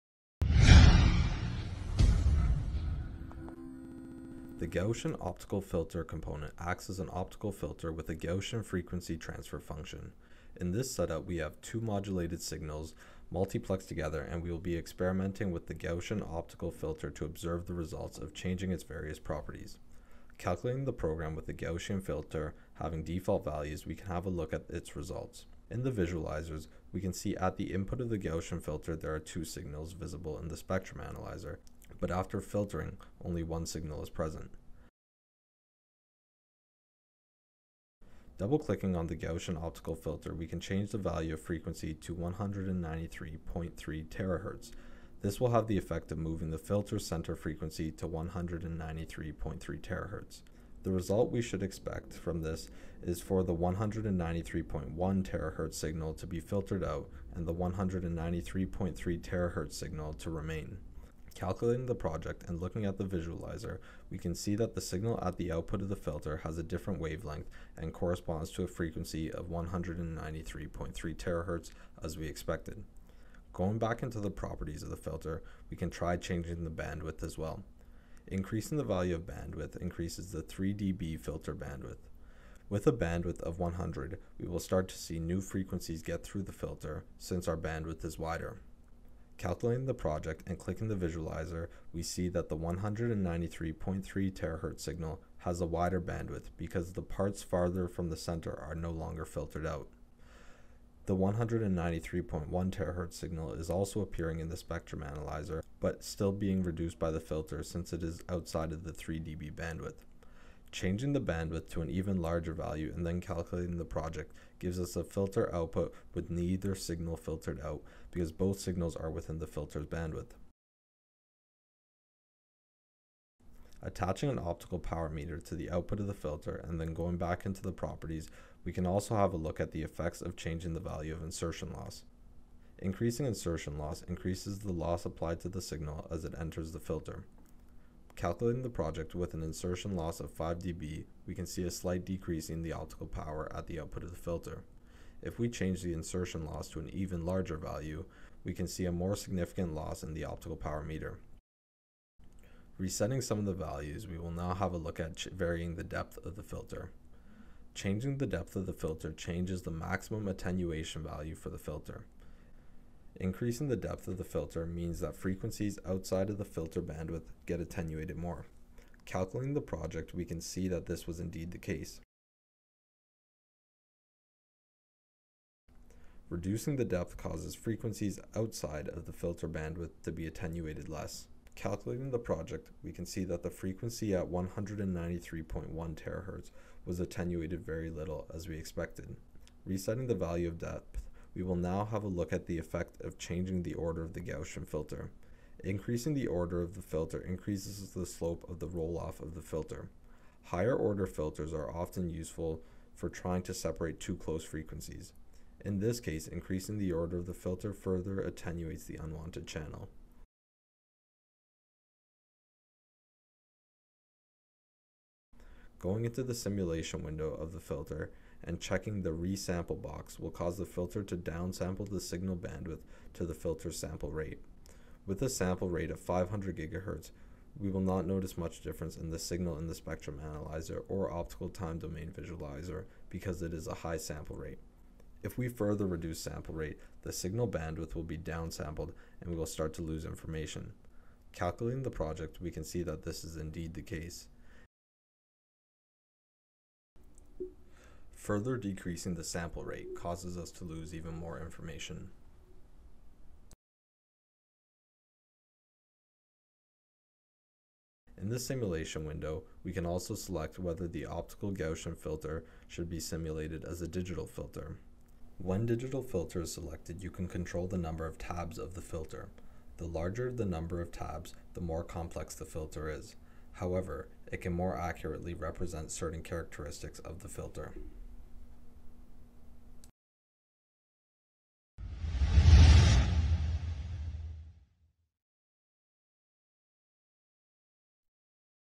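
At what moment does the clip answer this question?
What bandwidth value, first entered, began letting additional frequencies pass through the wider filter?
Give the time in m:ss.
1:23.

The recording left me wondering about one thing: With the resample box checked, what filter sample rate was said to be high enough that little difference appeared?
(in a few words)
500 GHz.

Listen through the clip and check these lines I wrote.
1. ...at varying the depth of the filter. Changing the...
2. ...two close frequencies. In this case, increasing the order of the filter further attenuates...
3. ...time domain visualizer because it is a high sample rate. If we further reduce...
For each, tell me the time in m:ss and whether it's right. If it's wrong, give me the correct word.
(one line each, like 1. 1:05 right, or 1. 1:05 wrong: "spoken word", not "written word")
1. 2:34 right
2. 3:23 right
3. 3:51 right.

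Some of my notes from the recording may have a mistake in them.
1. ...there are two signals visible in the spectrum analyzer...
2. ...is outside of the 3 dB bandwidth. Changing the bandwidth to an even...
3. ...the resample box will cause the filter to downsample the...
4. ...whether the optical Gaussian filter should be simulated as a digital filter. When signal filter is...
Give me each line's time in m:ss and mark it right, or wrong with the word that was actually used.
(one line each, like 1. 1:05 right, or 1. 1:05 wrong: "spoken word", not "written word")
1. 0:28 right
2. 1:48 right
3. 3:39 right
4. 4:20 wrong: "digital", not "signal".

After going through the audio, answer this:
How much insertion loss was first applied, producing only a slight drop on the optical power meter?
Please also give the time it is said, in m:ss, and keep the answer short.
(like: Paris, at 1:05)
5 dB, at 2:20.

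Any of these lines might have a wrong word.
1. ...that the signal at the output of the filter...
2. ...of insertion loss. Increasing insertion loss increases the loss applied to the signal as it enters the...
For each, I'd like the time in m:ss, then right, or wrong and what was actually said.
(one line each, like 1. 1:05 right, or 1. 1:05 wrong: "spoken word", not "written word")
1. 1:04 right
2. 2:11 right.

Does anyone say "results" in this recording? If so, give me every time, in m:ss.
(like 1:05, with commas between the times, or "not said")
0:17, 0:24, 0:50.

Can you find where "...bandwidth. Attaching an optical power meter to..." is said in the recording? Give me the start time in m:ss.
1:59.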